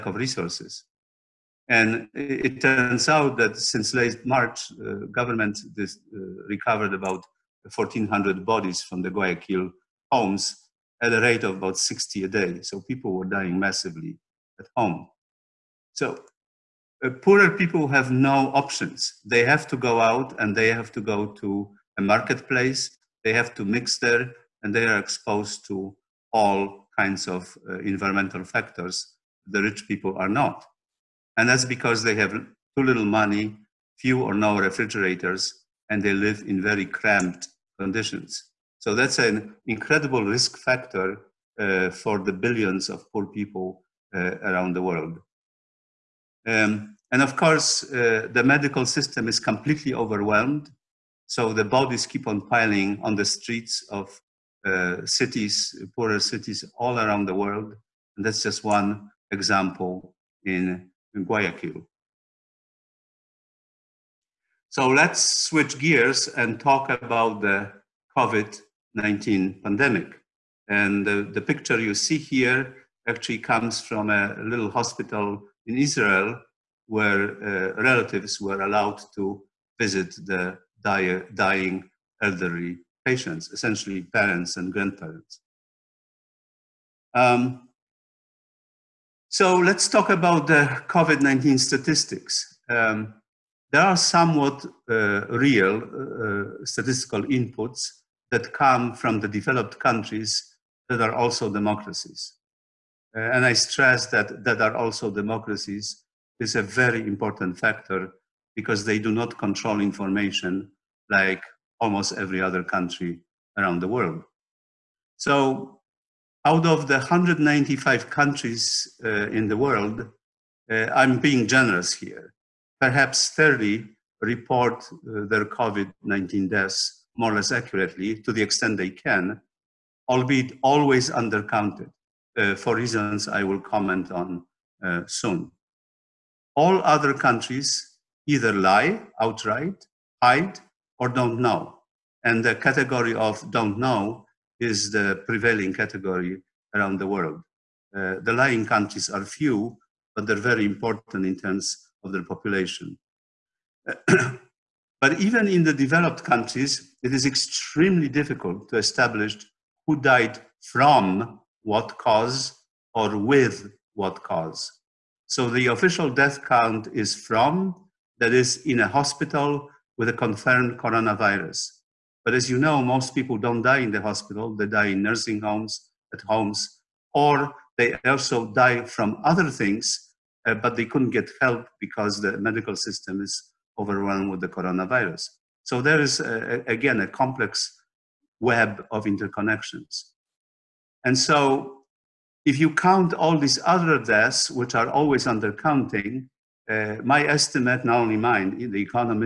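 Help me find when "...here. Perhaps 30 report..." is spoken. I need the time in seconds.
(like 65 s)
121 s.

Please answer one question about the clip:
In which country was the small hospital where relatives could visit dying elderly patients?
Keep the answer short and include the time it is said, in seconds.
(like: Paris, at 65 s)
Israel, at 75 s.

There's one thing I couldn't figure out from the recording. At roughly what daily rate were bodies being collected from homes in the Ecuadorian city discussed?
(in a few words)
60 a day.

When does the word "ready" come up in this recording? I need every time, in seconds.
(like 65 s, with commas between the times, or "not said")
not said.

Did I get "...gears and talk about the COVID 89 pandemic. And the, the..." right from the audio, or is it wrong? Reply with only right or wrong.
wrong.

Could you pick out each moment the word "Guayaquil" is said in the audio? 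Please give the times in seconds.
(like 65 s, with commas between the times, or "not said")
9 s, 61 s.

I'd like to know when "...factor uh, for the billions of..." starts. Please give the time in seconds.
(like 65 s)
40 s.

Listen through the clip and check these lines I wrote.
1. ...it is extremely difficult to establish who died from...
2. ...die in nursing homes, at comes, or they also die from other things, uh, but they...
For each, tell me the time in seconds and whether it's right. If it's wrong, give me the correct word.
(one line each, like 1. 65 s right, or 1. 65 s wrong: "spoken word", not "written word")
1. 157 s right
2. 174 s wrong: "homes", not "comes".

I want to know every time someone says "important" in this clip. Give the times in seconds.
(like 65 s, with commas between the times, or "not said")
107 s, 150 s.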